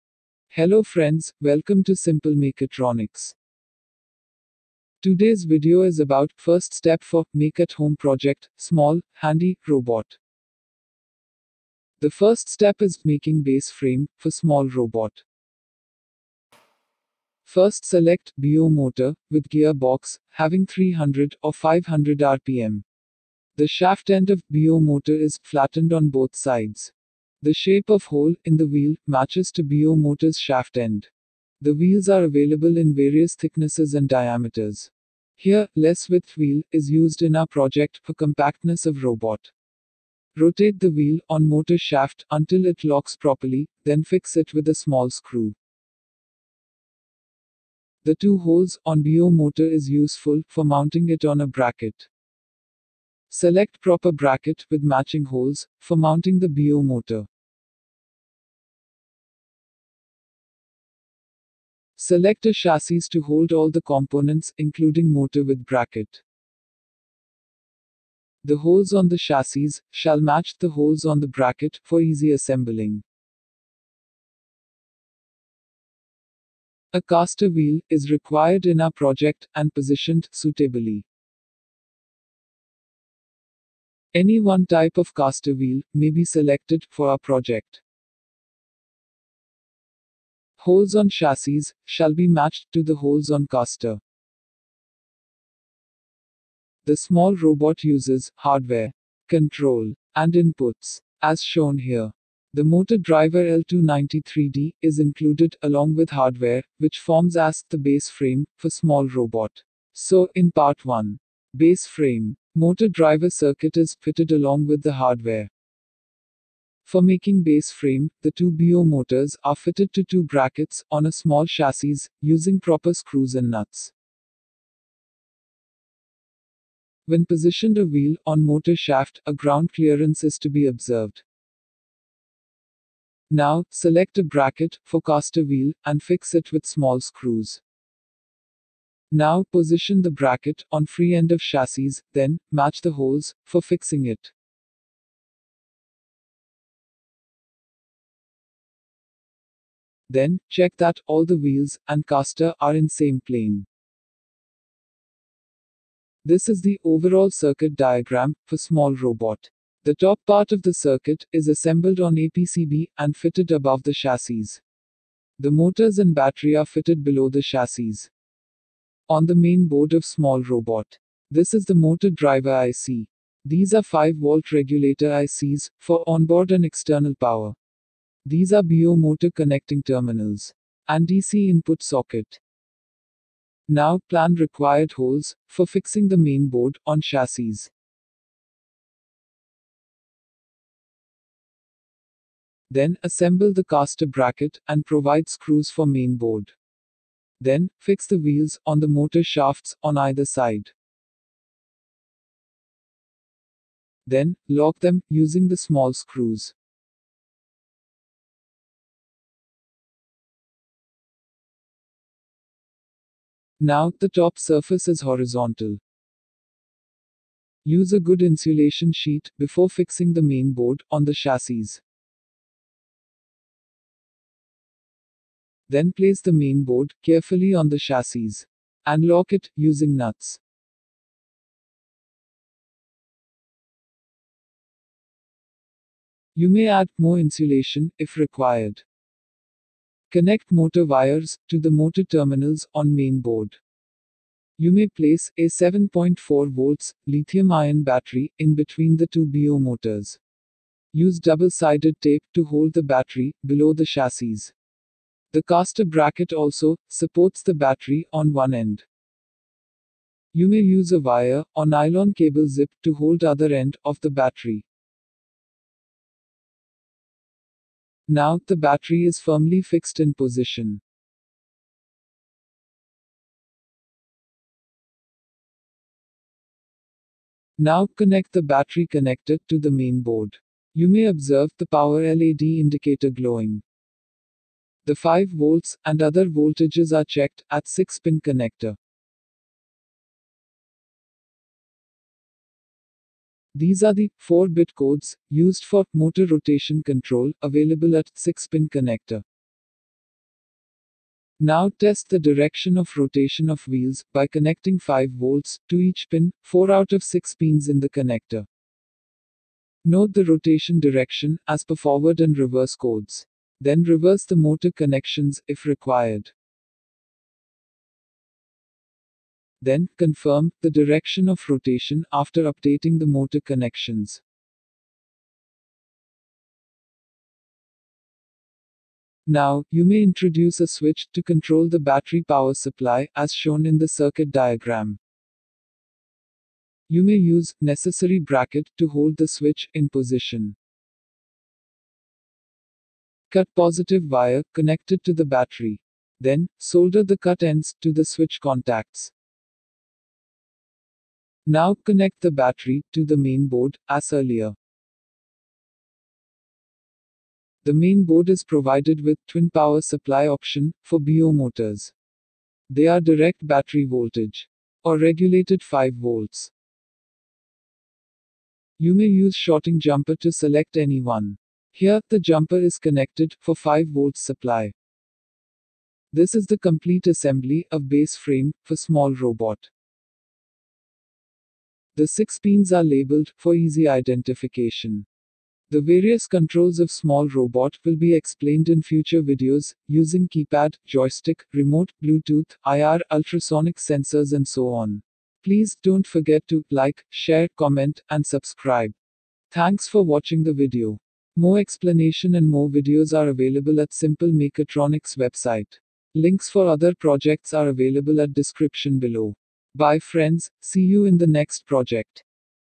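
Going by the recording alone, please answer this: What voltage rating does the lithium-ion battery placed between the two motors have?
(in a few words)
7.4 volts.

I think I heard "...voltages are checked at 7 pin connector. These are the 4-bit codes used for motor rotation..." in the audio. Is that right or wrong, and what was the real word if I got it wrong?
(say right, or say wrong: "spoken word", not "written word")
wrong: "6", not "7".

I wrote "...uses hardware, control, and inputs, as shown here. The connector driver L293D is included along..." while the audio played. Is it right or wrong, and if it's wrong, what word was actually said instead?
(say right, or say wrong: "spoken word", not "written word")
wrong: "motor", not "connector".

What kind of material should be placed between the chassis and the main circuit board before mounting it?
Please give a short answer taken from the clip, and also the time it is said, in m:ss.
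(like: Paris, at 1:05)
insulation sheet, at 3:38.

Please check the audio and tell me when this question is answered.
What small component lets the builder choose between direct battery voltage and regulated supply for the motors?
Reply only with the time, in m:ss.
6:09.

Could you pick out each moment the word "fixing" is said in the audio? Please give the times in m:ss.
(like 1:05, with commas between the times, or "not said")
2:23, 3:05, 3:39.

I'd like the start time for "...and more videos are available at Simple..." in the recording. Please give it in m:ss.
6:42.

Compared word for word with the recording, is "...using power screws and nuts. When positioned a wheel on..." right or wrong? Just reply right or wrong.
wrong.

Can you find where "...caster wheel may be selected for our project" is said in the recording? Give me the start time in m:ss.
1:25.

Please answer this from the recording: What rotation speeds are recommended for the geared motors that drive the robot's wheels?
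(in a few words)
300 or 500 rpm.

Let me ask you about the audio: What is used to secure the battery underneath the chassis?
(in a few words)
double-sided tape.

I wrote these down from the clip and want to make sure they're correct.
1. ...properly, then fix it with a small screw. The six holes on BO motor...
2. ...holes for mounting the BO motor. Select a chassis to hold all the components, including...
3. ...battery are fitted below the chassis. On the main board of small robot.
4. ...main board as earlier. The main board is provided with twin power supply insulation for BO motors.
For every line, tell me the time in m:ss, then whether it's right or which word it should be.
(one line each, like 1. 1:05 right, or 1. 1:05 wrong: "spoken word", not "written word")
1. 0:43 wrong: "two", not "six"
2. 0:55 right
3. 2:46 right
4. 5:53 wrong: "option", not "insulation".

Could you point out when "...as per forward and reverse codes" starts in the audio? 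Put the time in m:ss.
5:11.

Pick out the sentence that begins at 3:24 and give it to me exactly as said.
Then lock them using the small screws.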